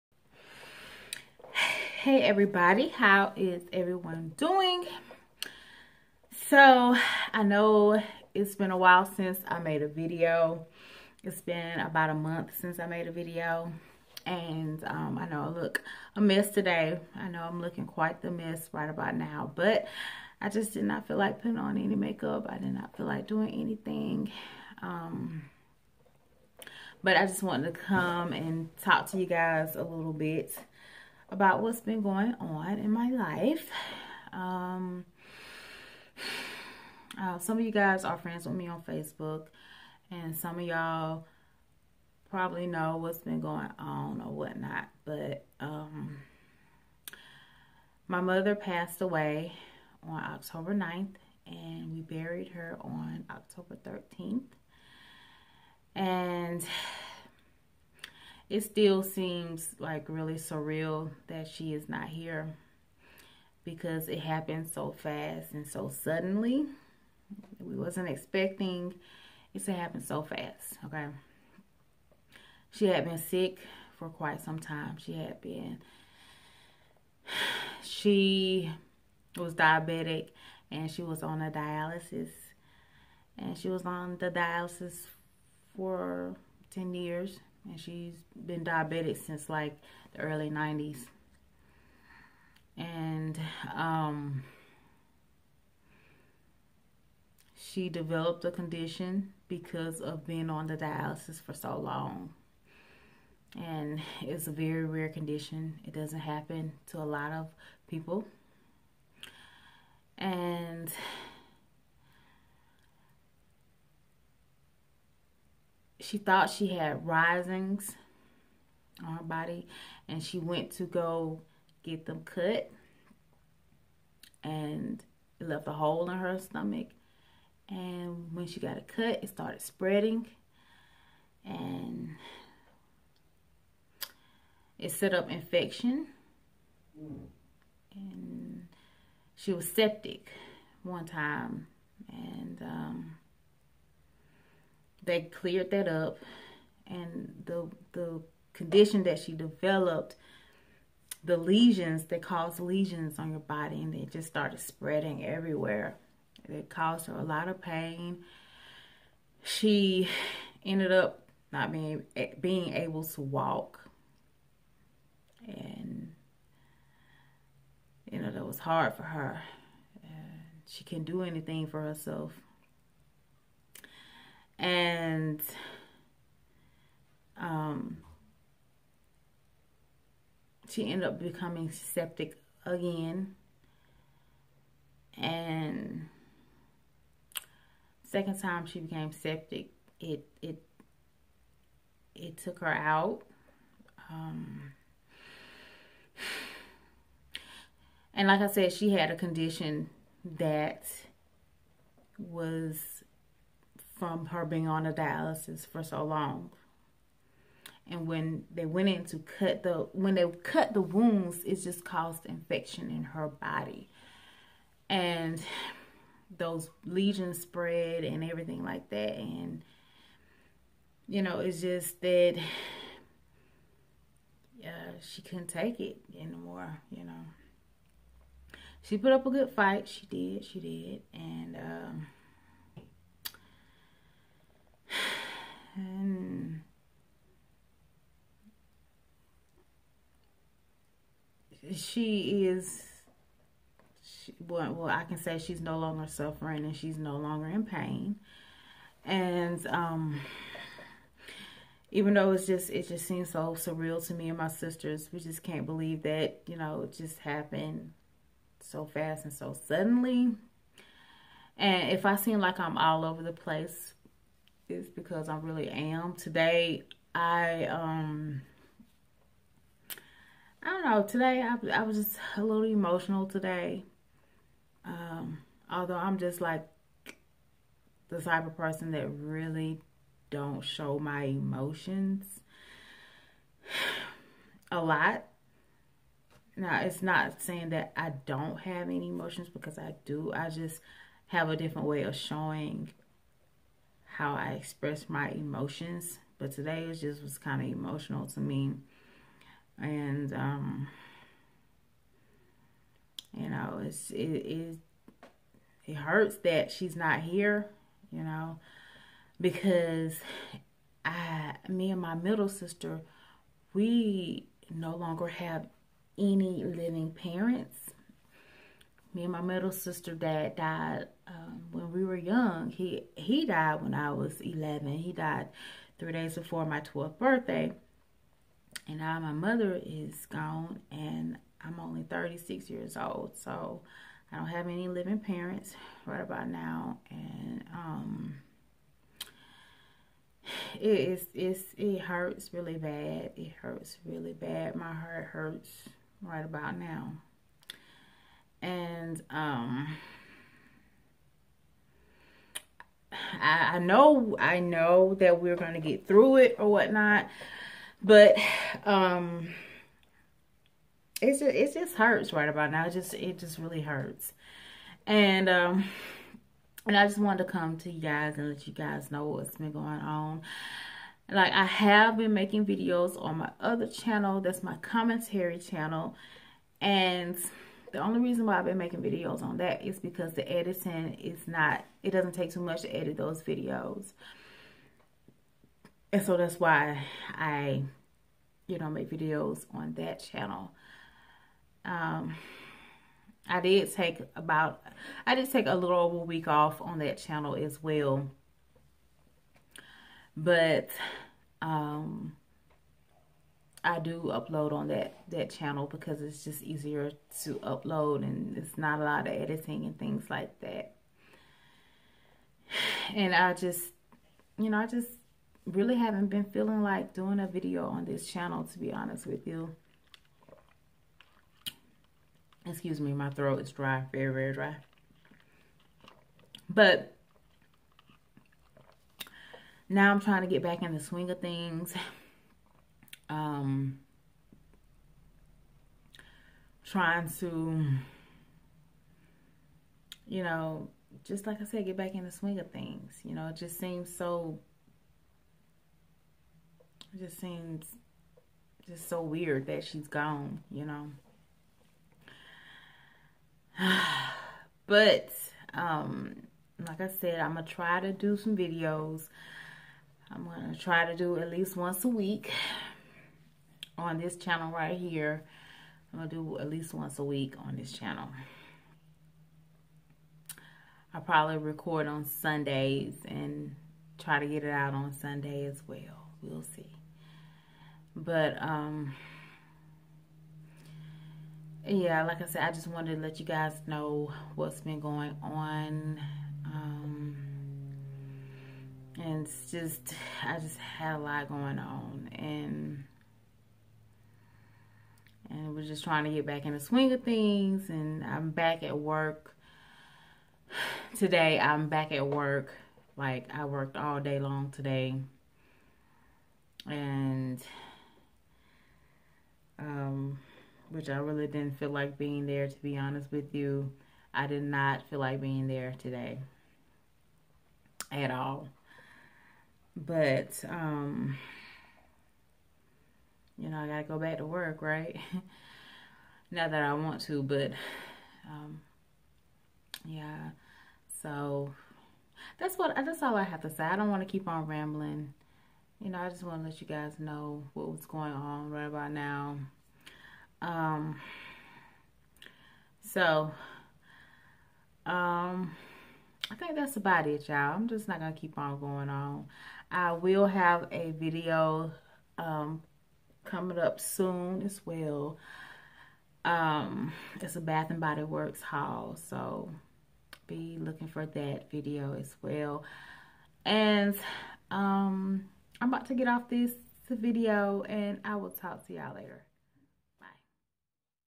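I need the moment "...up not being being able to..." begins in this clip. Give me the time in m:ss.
2:40.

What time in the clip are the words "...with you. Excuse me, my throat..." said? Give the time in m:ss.
6:59.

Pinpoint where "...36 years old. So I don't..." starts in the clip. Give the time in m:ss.
5:32.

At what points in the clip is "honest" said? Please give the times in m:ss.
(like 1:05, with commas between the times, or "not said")
6:58, 8:32.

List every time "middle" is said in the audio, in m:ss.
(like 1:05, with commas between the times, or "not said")
5:12, 5:19.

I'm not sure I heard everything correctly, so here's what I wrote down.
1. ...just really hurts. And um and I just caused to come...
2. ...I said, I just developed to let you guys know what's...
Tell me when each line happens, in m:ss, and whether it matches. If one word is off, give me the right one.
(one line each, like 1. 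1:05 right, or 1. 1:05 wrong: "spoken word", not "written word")
1. 6:03 wrong: "wanted", not "caused"
2. 8:02 wrong: "wanted", not "developed".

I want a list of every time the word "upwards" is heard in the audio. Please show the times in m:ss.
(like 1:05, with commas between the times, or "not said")
not said.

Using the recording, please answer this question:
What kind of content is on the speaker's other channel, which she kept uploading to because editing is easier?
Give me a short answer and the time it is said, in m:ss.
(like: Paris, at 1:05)
commentary, at 6:14.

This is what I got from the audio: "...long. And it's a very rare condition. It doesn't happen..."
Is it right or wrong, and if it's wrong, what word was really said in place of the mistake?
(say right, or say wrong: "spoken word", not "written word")
right.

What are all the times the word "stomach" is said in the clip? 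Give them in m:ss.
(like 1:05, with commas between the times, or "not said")
2:06.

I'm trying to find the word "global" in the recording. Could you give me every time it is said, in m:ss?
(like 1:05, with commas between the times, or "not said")
not said.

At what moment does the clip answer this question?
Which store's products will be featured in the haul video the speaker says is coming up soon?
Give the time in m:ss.
9:17.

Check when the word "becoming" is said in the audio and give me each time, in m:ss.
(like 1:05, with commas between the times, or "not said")
3:01.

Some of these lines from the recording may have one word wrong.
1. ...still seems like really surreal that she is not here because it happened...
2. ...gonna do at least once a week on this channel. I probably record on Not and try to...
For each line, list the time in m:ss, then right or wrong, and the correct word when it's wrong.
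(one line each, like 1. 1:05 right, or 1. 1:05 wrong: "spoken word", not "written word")
1. 0:58 right
2. 7:46 wrong: "Sundays", not "Not".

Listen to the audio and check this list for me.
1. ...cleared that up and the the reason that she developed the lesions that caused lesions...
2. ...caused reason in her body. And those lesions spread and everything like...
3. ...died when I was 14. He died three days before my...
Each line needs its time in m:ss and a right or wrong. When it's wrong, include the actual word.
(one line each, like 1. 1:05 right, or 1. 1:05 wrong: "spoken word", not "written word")
1. 2:25 wrong: "condition", not "reason"
2. 3:31 wrong: "infection", not "reason"
3. 5:23 wrong: "11", not "14".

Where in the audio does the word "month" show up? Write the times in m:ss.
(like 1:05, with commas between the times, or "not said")
0:12.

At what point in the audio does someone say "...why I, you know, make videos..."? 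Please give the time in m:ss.
6:26.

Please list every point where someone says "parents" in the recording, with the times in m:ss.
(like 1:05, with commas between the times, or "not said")
5:17, 5:35.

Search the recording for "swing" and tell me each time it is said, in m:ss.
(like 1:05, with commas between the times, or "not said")
7:10, 7:22, 8:16.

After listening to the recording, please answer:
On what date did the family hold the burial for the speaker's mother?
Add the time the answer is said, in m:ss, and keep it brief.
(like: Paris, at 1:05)
October 13th, at 0:53.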